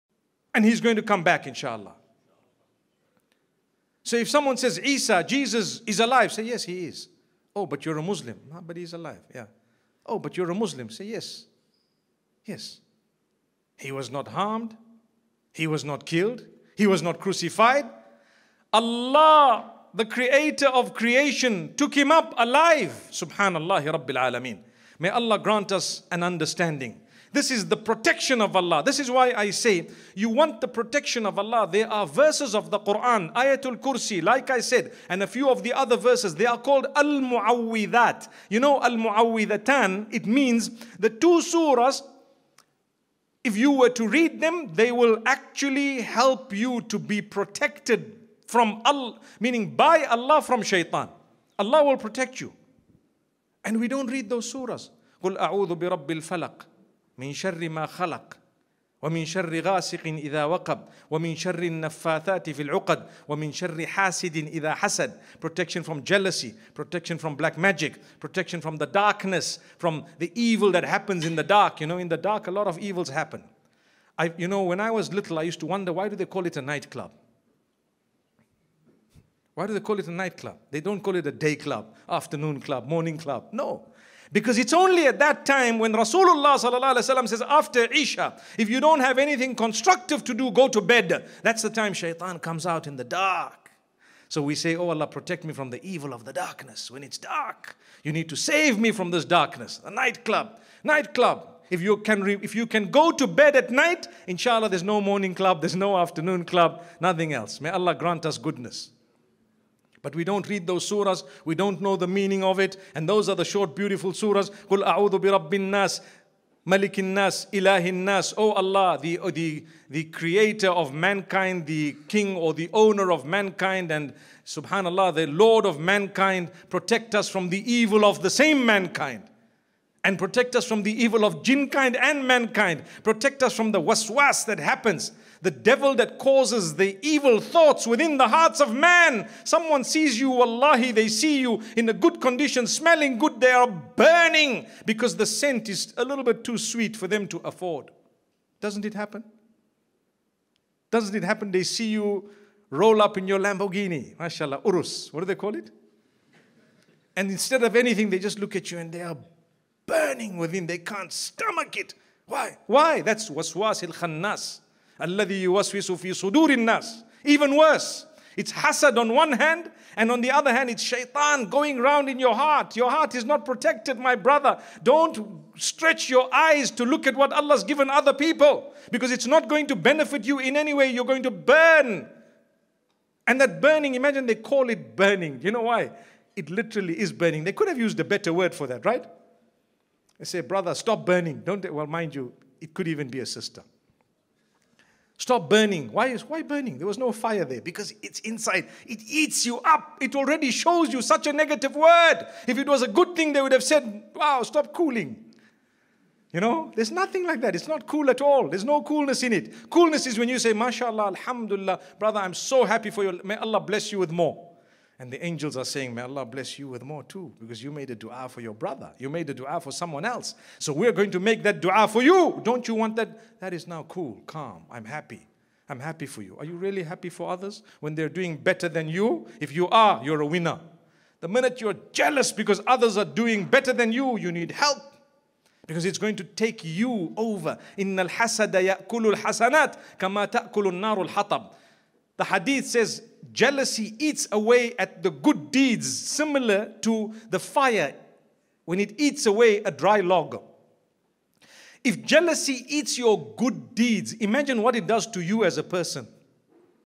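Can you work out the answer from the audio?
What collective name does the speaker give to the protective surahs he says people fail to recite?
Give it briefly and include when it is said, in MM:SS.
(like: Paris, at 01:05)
Al Muawwidat, at 00:36.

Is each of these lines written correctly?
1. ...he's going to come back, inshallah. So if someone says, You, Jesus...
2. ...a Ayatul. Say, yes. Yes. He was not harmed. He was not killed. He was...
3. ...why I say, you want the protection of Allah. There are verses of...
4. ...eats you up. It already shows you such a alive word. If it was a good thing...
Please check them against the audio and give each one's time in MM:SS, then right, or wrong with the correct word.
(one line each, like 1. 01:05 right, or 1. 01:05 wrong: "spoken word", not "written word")
1. 00:00 wrong: "Isa", not "You"
2. 00:10 wrong: "Muslim", not "Ayatul"
3. 00:29 right
4. 03:19 wrong: "negative", not "alive".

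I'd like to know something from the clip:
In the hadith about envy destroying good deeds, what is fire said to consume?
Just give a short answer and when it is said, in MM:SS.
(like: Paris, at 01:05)
dry log, at 04:09.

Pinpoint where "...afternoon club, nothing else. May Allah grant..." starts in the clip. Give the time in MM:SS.
01:45.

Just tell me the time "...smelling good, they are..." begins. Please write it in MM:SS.
02:22.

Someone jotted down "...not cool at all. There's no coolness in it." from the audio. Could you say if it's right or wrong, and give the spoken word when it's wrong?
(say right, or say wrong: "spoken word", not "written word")
right.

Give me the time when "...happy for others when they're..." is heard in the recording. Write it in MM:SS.
03:46.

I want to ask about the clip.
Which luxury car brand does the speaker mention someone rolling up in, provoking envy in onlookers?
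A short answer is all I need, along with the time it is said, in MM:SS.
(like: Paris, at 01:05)
Lamborghini, at 02:33.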